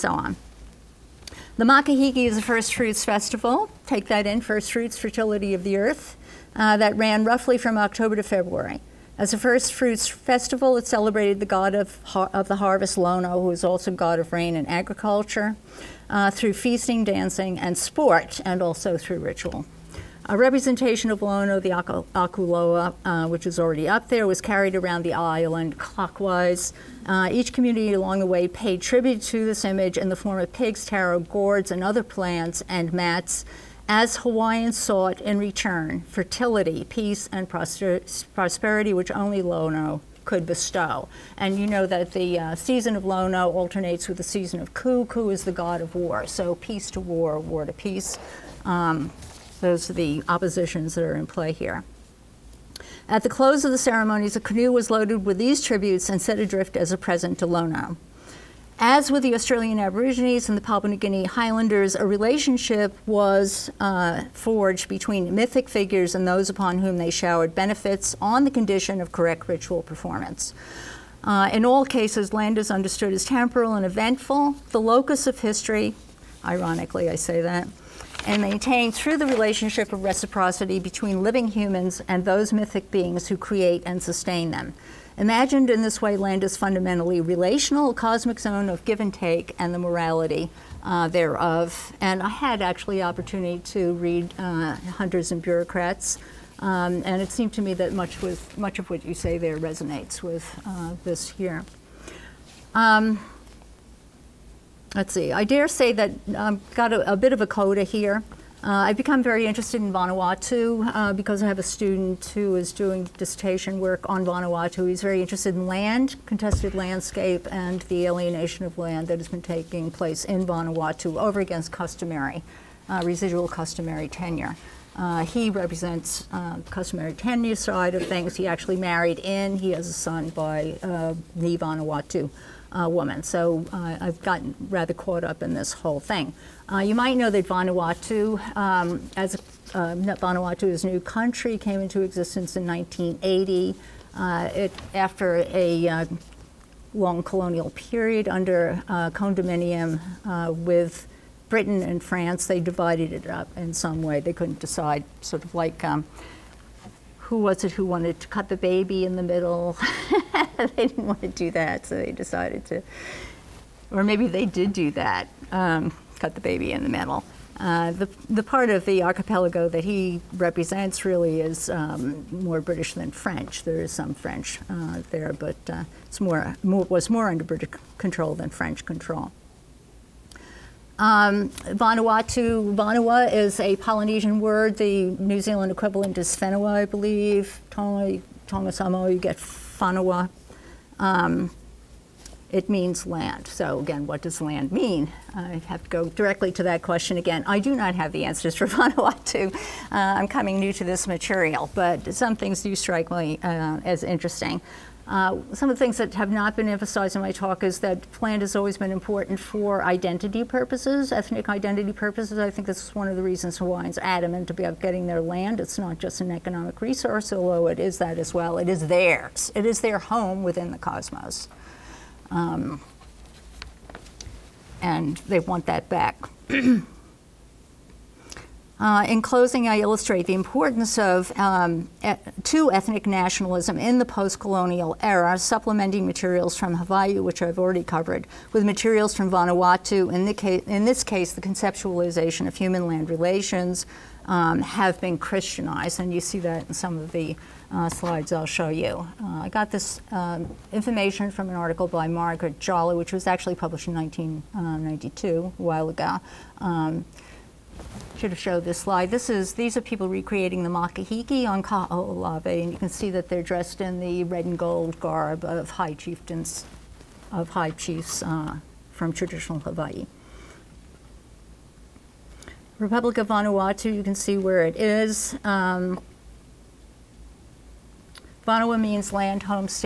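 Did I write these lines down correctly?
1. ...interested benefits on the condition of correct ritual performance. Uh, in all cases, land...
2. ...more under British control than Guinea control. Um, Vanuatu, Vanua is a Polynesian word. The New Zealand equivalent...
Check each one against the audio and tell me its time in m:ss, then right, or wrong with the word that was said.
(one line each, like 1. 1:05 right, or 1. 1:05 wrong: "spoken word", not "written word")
1. 1:07 wrong: "showered", not "interested"
2. 2:57 wrong: "French", not "Guinea".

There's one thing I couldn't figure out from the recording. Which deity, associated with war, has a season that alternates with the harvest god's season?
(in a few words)
Ku.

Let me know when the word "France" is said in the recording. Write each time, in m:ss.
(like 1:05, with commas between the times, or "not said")
2:32.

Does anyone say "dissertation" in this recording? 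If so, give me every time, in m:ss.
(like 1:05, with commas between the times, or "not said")
1:53.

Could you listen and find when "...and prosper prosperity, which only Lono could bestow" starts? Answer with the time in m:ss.
0:37.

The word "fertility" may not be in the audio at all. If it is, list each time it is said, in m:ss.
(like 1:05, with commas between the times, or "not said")
0:04, 0:36.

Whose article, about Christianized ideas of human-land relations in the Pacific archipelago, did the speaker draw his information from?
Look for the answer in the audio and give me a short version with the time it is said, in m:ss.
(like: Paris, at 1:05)
Margaret Jolly, at 4:12.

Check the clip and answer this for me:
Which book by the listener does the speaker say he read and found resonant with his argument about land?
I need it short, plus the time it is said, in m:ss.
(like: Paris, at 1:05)
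Hunters and Bureaucrats, at 1:34.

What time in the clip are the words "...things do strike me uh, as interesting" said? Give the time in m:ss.
3:22.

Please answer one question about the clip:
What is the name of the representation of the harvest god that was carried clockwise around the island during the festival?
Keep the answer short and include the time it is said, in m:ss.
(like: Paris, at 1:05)
Akuloa, at 0:21.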